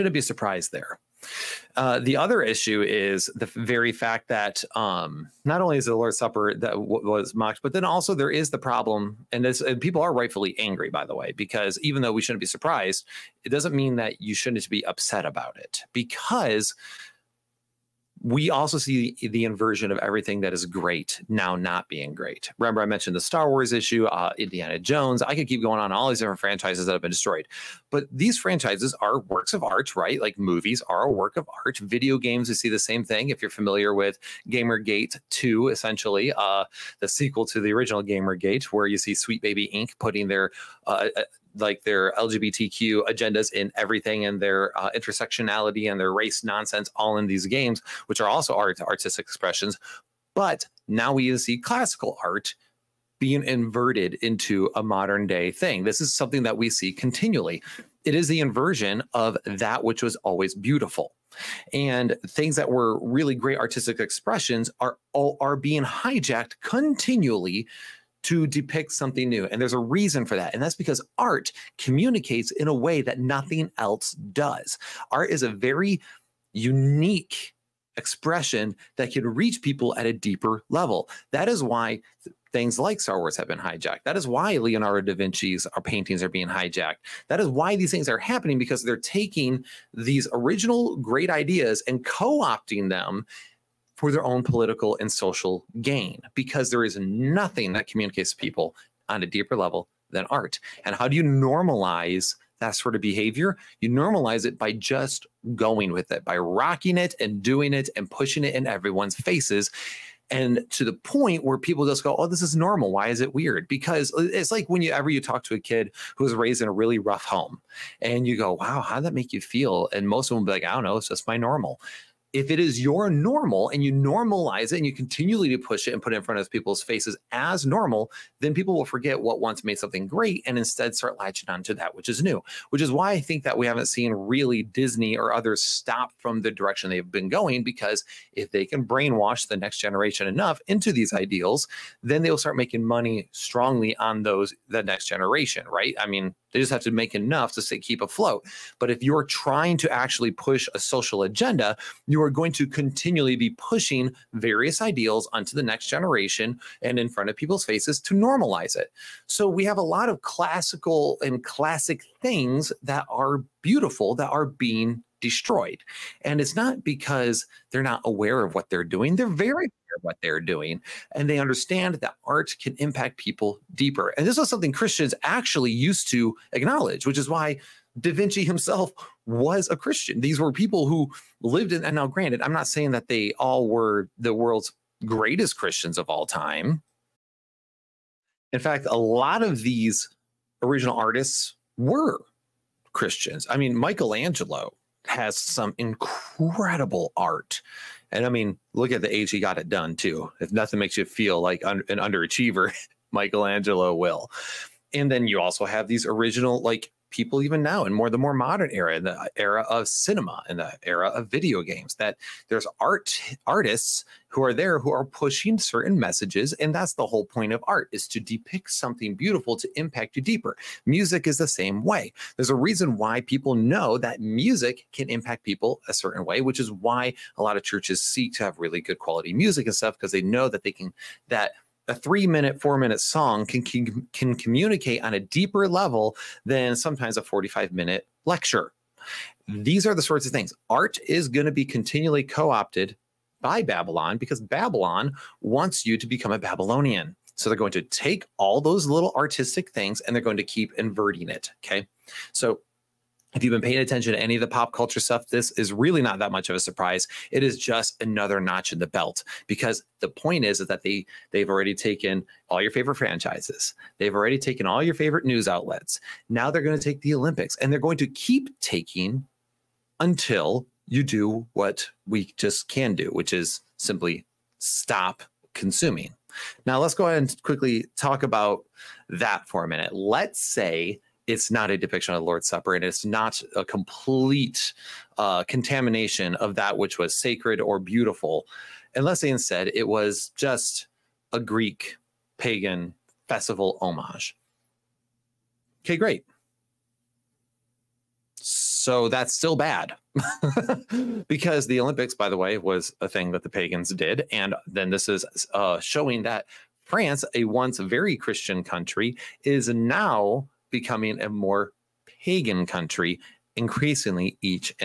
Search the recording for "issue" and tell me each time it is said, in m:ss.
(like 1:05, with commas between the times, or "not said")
0:02, 0:23.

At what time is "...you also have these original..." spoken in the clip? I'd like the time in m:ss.
3:25.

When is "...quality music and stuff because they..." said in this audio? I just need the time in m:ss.
3:48.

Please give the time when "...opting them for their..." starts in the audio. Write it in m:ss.
1:32.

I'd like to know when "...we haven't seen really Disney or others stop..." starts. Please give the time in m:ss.
2:13.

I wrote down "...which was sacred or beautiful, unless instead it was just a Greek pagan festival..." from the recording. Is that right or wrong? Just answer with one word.
right.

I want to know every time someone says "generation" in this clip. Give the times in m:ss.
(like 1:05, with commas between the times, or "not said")
2:19, 2:25, 2:35.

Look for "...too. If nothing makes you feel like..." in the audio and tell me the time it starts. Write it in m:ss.
3:19.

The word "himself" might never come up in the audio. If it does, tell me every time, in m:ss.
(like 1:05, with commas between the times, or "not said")
2:58.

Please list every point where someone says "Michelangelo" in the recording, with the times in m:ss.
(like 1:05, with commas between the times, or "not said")
3:13, 3:23.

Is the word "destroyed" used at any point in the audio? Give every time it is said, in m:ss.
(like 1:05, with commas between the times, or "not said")
0:27, 2:45.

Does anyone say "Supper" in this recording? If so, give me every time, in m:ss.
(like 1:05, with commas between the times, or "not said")
0:06, 4:42.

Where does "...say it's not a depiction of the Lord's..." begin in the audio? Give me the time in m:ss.
4:40.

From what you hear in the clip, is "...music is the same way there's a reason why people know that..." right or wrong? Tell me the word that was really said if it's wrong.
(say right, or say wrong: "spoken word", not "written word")
right.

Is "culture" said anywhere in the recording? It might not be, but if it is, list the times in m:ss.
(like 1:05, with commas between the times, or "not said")
4:14.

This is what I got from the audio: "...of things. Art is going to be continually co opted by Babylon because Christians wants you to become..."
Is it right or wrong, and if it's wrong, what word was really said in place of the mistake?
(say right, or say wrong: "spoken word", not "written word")
wrong: "Babylon", not "Christians".